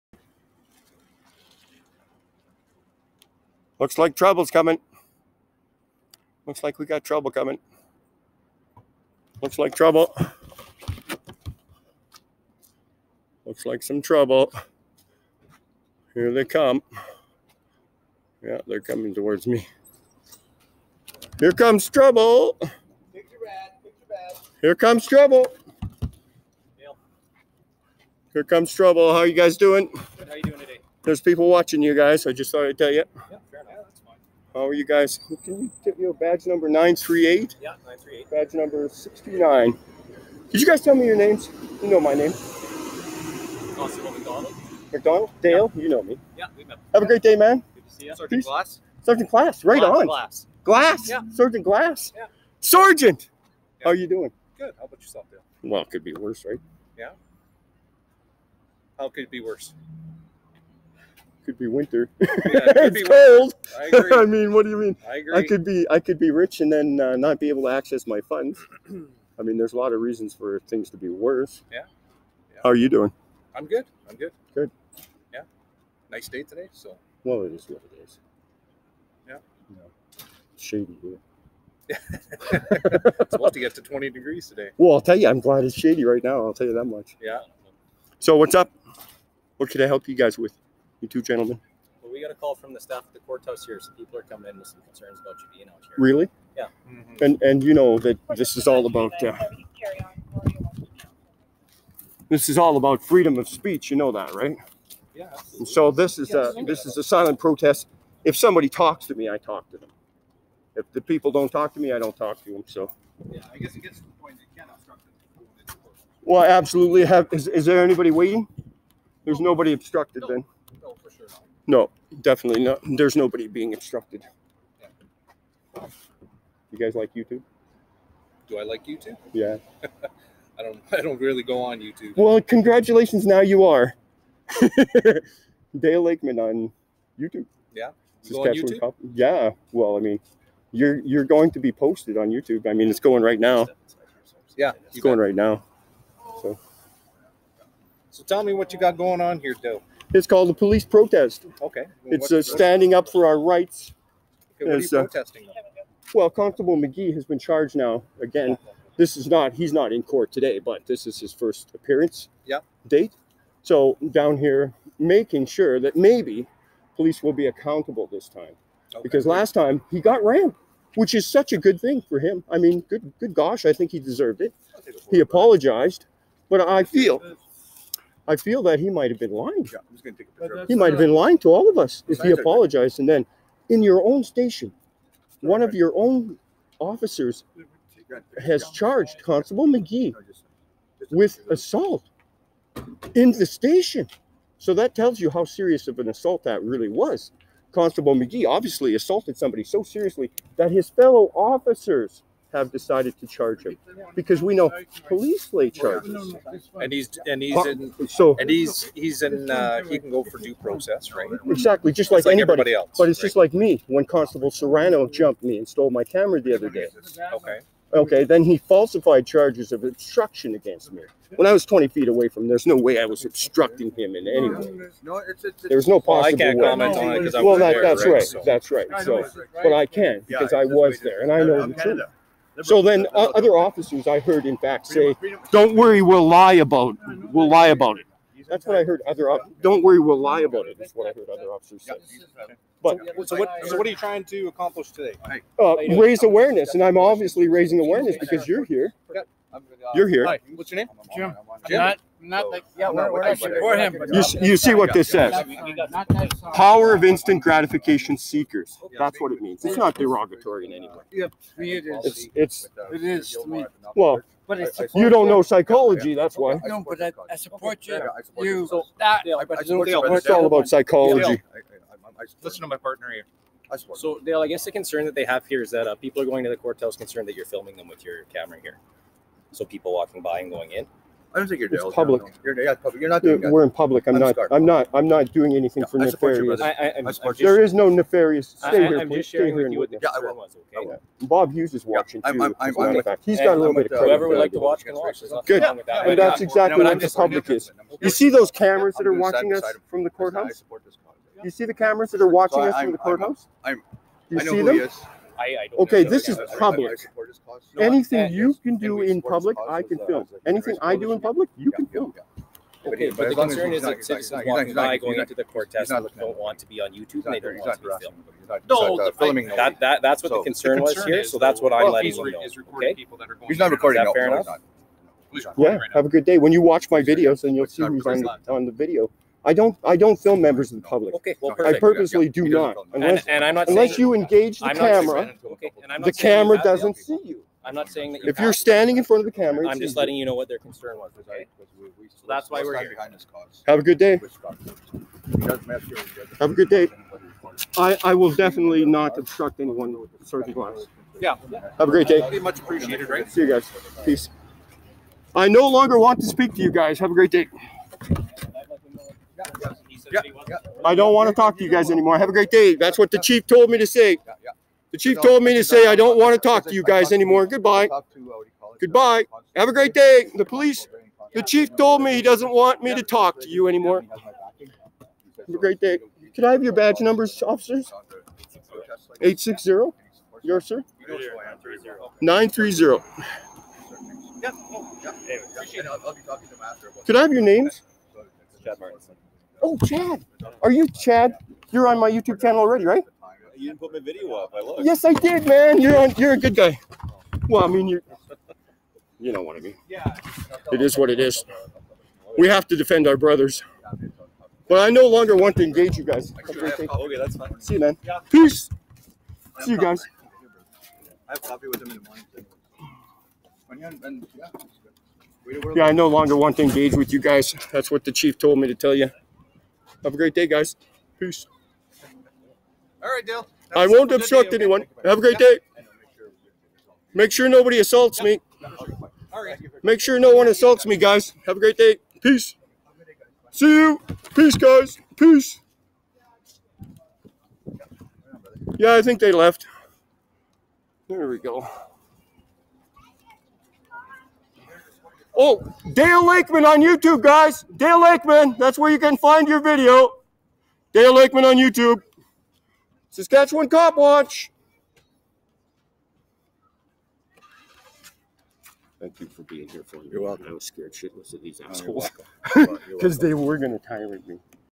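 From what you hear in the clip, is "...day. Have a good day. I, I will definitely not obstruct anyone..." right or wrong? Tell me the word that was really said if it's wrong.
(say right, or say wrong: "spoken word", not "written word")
right.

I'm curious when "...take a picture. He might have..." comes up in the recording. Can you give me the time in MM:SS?
03:00.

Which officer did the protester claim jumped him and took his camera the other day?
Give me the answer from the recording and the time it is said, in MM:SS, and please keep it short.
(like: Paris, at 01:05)
Constable Serrano, at 03:34.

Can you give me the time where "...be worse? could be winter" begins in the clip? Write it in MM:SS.
00:59.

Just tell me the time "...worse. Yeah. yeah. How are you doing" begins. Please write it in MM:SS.
01:11.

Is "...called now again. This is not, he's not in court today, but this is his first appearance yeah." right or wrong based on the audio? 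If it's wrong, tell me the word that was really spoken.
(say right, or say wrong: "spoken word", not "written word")
wrong: "charged", not "called".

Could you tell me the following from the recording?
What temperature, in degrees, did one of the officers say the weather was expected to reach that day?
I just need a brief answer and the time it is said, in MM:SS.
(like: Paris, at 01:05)
20 degrees, at 01:23.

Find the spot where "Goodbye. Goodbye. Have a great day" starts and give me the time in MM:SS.
06:07.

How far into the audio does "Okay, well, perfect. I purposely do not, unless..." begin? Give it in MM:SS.
05:31.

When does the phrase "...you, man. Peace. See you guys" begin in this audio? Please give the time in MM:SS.
06:47.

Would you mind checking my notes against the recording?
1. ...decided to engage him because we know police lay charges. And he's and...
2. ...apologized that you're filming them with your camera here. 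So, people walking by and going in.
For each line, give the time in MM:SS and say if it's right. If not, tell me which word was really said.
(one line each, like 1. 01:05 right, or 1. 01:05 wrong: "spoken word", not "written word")
1. 03:22 wrong: "charge", not "engage"
2. 04:36 wrong: "concerned", not "apologized".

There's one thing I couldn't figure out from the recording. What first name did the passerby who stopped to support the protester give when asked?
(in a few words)
Jim.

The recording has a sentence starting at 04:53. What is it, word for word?
He's got a little bit of uh, credit.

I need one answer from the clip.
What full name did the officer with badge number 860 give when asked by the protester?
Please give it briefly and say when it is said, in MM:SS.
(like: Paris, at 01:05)
Chad Martinson, at 06:28.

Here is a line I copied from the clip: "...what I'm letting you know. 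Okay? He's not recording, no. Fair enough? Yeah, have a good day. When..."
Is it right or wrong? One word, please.
right.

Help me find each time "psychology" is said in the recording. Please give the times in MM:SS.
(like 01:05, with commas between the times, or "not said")
04:25, 04:30.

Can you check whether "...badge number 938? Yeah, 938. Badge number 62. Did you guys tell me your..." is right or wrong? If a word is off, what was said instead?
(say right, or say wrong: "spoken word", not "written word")
wrong: "69", not "62".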